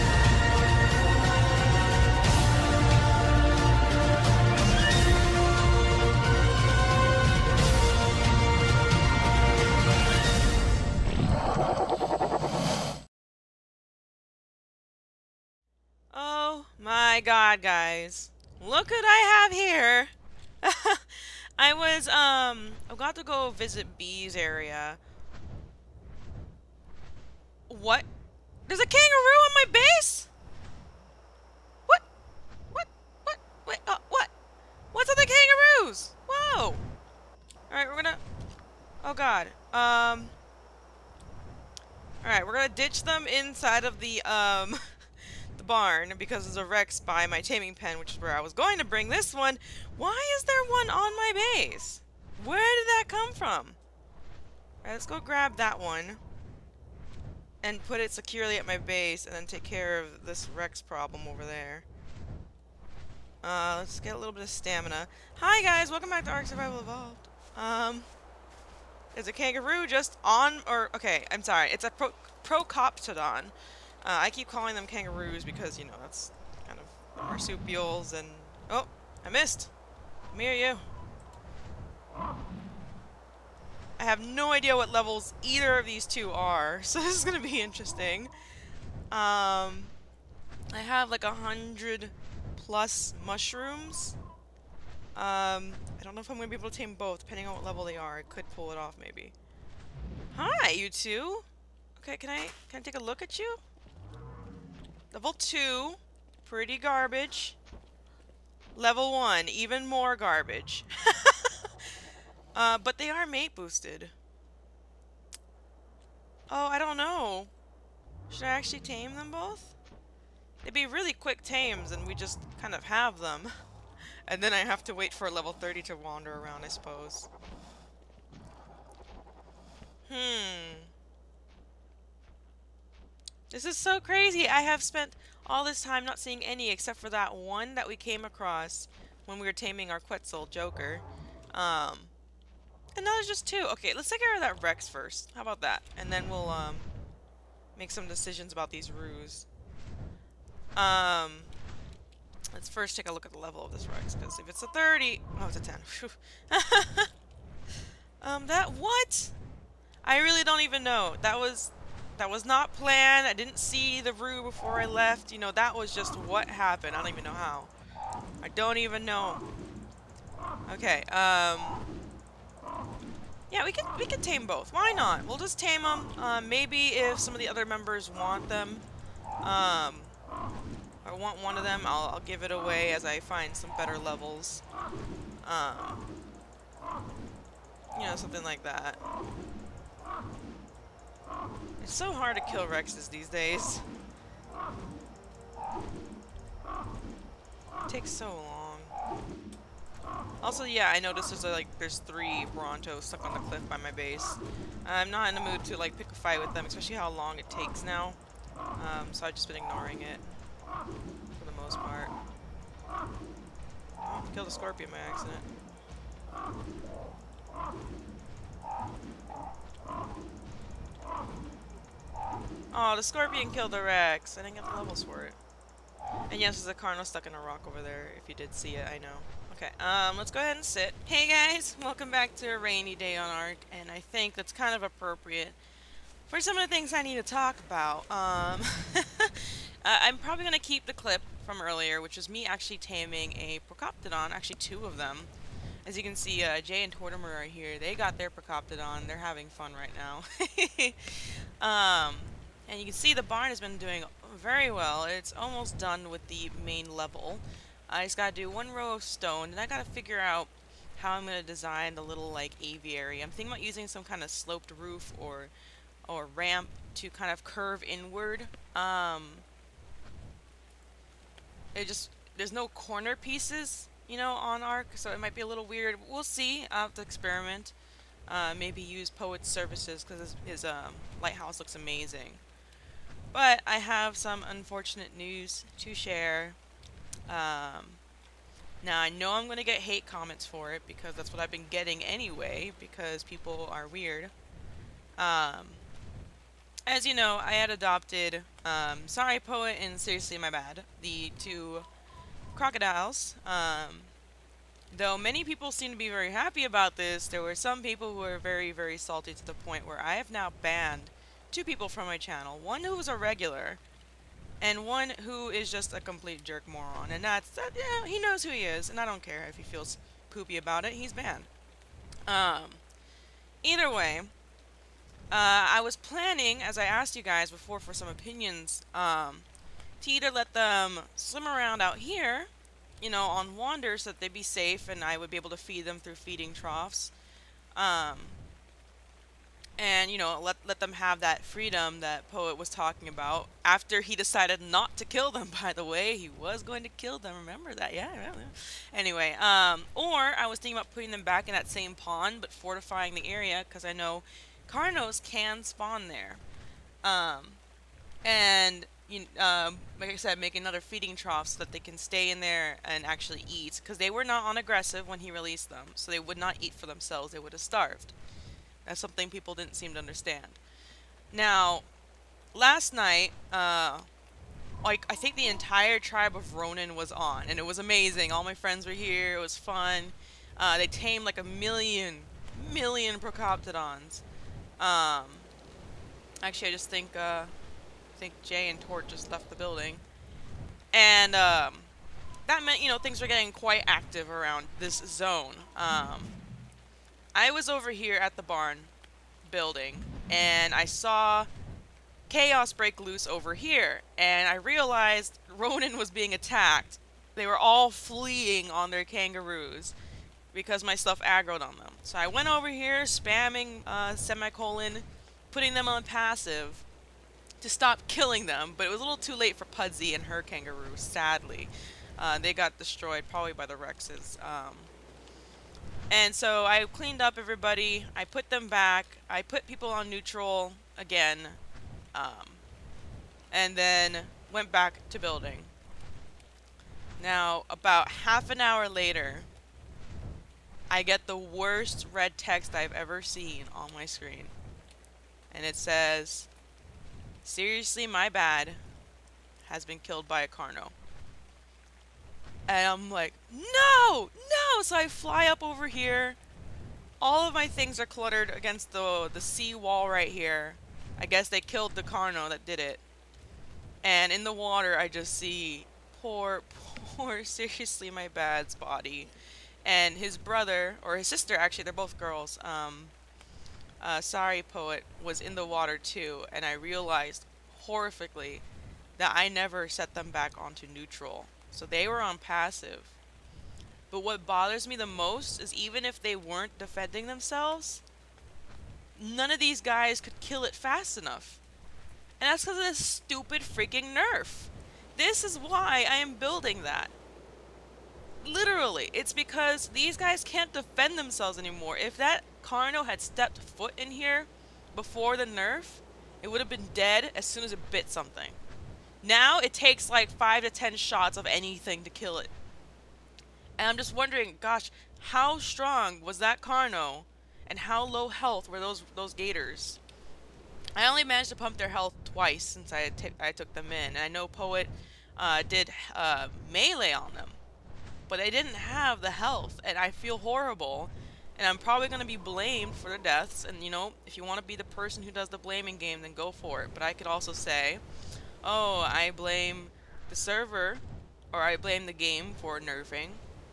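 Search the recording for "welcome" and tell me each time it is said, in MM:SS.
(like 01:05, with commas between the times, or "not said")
01:05, 03:51.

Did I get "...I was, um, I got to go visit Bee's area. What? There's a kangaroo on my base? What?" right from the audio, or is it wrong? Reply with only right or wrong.
right.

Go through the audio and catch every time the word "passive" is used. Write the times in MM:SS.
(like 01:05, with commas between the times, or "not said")
06:56, 08:02.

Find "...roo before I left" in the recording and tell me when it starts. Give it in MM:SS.
02:44.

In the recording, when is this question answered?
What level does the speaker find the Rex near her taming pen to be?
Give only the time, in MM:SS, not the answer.
02:35.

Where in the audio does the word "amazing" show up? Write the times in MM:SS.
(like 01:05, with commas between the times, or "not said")
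04:41, 06:17.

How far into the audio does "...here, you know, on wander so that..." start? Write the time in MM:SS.
05:31.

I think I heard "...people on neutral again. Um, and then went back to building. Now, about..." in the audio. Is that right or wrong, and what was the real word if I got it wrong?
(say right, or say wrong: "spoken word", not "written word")
right.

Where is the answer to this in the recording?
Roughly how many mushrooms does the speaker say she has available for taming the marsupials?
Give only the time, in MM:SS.
01:31.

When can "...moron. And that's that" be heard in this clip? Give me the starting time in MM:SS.
05:16.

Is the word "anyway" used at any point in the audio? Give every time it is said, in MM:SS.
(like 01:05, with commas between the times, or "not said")
04:52, 05:48.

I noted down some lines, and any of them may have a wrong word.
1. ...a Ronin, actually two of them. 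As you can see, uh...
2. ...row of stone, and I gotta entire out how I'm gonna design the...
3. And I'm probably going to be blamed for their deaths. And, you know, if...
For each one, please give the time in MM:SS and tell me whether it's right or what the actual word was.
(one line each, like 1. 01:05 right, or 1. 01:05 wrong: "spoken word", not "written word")
1. 04:03 wrong: "Procoptodon", not "Ronin"
2. 04:18 wrong: "figure", not "entire"
3. 08:51 right.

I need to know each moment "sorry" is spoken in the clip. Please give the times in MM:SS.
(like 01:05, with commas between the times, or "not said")
01:11, 04:59, 07:54.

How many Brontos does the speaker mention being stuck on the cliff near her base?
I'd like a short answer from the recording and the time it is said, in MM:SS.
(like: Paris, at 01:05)
3, at 03:21.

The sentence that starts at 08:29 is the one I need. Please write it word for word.
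Now it takes like 5 to 10 shots of anything to kill it.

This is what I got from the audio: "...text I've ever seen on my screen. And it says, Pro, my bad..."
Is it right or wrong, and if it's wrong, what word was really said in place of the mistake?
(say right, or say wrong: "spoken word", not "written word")
wrong: "Seriously", not "Pro".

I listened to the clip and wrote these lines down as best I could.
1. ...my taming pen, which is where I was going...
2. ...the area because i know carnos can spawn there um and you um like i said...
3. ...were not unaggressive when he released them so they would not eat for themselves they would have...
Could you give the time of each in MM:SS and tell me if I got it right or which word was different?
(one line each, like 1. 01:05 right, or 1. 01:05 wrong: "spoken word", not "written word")
1. 00:47 right
2. 05:53 right
3. 06:04 right.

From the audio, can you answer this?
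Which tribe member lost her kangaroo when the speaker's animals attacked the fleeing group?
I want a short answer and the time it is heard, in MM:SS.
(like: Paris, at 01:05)
Puddzee, at 06:59.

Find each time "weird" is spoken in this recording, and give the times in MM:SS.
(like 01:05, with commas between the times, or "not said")
04:35, 04:53.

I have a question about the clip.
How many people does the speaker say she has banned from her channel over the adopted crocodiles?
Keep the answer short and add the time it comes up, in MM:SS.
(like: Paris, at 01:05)
2, at 05:11.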